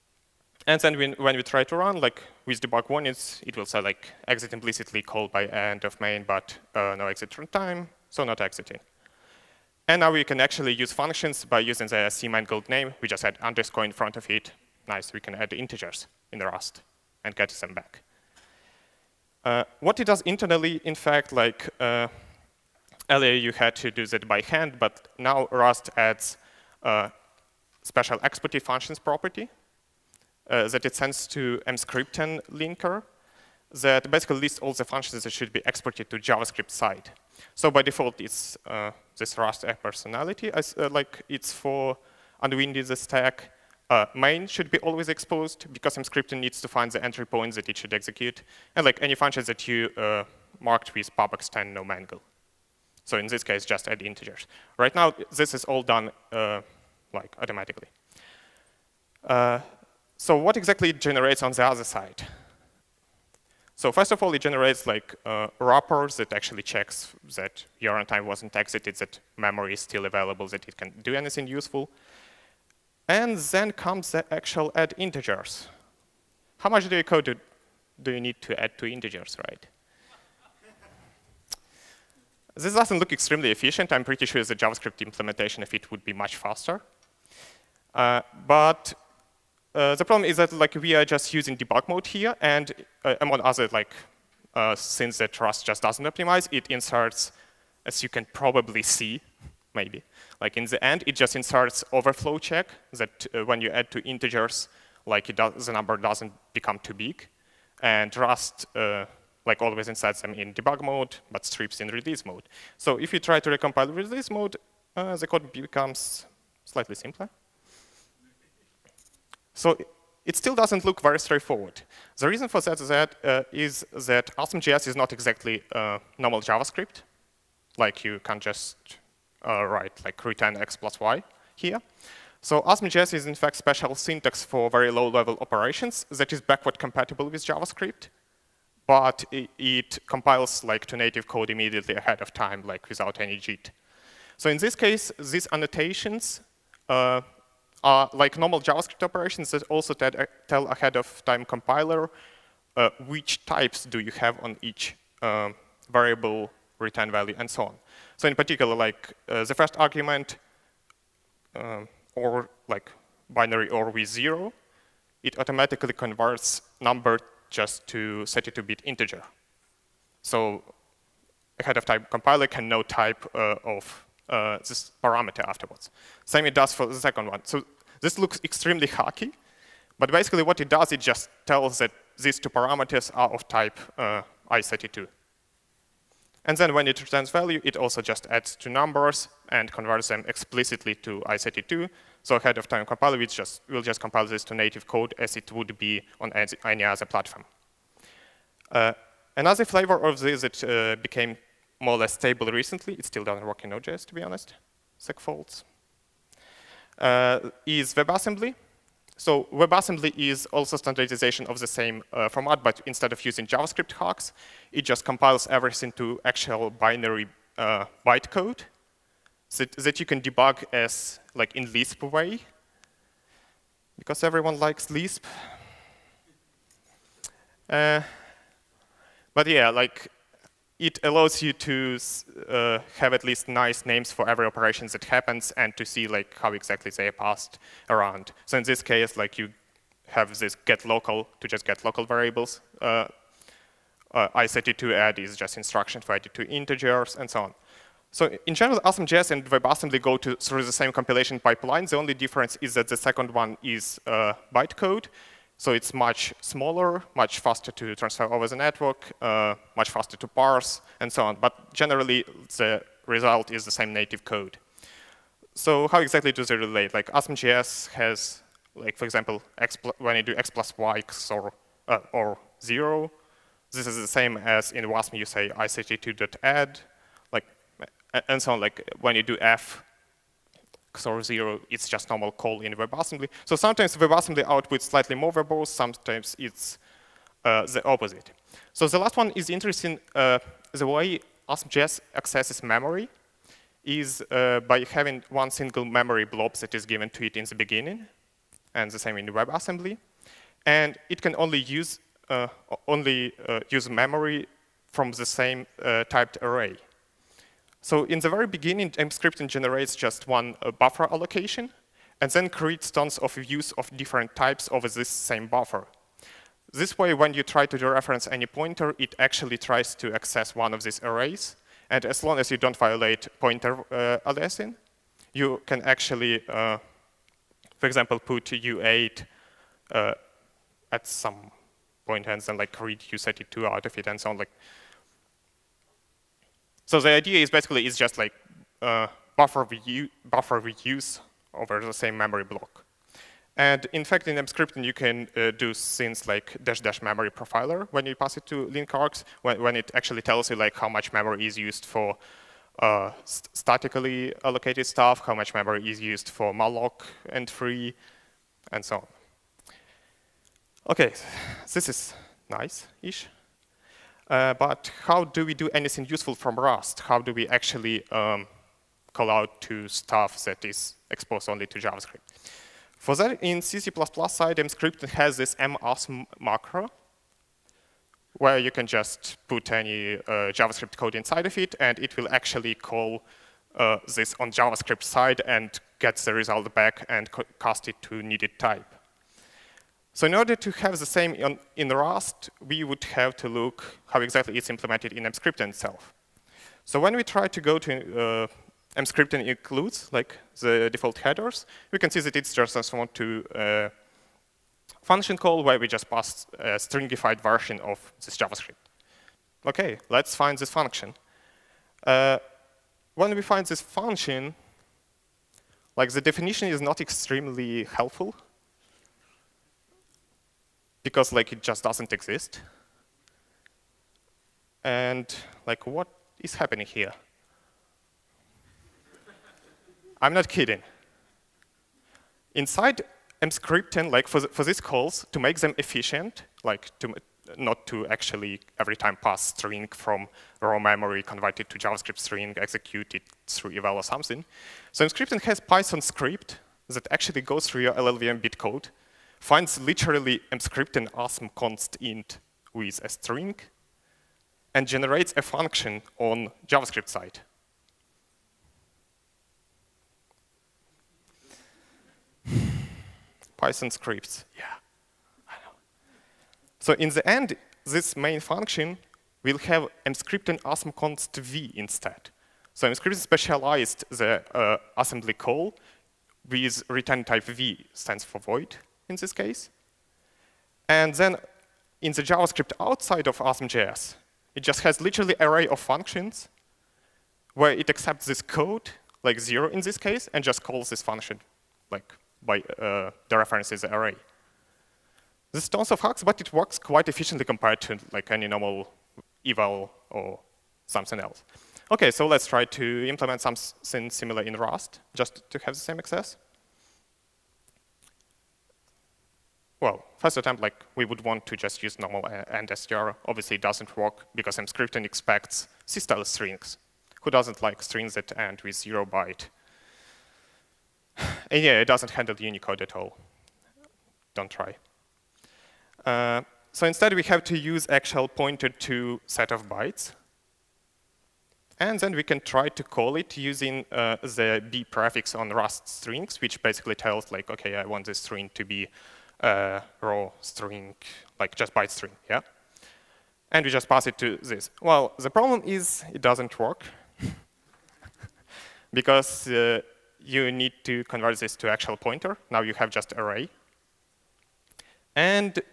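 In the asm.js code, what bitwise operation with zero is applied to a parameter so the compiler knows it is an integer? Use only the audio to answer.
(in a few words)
Binary OR.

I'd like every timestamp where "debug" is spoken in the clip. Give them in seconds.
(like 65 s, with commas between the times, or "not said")
2 s, 91 s, 110 s, 220 s.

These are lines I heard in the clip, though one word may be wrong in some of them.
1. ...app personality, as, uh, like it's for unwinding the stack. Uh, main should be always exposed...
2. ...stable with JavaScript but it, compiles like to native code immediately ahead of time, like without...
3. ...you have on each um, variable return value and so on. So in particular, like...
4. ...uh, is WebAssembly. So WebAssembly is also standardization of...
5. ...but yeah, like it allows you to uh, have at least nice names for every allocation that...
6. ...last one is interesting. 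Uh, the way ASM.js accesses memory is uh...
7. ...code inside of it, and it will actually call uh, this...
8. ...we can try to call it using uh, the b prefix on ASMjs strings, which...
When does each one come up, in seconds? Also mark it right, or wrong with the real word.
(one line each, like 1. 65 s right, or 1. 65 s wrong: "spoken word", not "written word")
1. 39 s right
2. 136 s wrong: "compatible", not "stable"
3. 153 s right
4. 206 s right
5. 229 s wrong: "operation", not "allocation"
6. 288 s right
7. 380 s right
8. 532 s wrong: "Rust", not "ASMjs".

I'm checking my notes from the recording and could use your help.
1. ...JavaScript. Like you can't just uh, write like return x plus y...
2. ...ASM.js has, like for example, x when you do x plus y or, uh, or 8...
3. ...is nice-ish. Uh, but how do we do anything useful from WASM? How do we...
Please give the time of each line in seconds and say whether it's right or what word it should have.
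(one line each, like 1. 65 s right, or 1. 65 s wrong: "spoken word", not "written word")
1. 126 s right
2. 267 s wrong: "0", not "8"
3. 361 s wrong: "Rust", not "WASM".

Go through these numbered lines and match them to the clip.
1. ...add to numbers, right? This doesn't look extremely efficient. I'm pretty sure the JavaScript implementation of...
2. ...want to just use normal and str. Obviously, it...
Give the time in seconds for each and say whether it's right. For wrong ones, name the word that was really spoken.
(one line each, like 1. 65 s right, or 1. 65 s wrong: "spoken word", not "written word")
1. 78 s wrong: "integers", not "numbers"
2. 511 s right.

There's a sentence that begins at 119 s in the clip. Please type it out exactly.
So it still doesn't look very straightforward.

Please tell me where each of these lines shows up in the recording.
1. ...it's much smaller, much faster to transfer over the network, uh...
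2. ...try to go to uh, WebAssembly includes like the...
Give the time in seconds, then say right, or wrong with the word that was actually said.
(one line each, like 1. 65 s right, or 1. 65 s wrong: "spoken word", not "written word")
1. 255 s right
2. 397 s wrong: "Emscripten", not "WebAssembly".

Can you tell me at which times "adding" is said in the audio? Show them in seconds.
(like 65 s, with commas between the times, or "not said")
246 s.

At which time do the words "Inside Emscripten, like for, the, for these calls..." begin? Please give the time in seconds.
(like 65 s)
432 s.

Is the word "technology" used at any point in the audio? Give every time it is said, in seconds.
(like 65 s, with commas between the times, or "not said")
not said.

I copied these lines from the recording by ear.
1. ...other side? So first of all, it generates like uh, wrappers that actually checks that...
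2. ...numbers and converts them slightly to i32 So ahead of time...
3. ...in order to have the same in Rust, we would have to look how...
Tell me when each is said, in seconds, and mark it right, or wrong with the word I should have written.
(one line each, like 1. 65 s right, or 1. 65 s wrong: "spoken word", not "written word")
1. 61 s right
2. 188 s wrong: "explicitly", not "slightly"
3. 390 s right.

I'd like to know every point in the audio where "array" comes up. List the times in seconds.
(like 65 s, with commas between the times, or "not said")
306 s, 321 s, 485 s, 493 s, 553 s.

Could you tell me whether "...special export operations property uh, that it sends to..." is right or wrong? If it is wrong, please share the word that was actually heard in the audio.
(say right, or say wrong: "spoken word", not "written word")
wrong: "functions", not "operations".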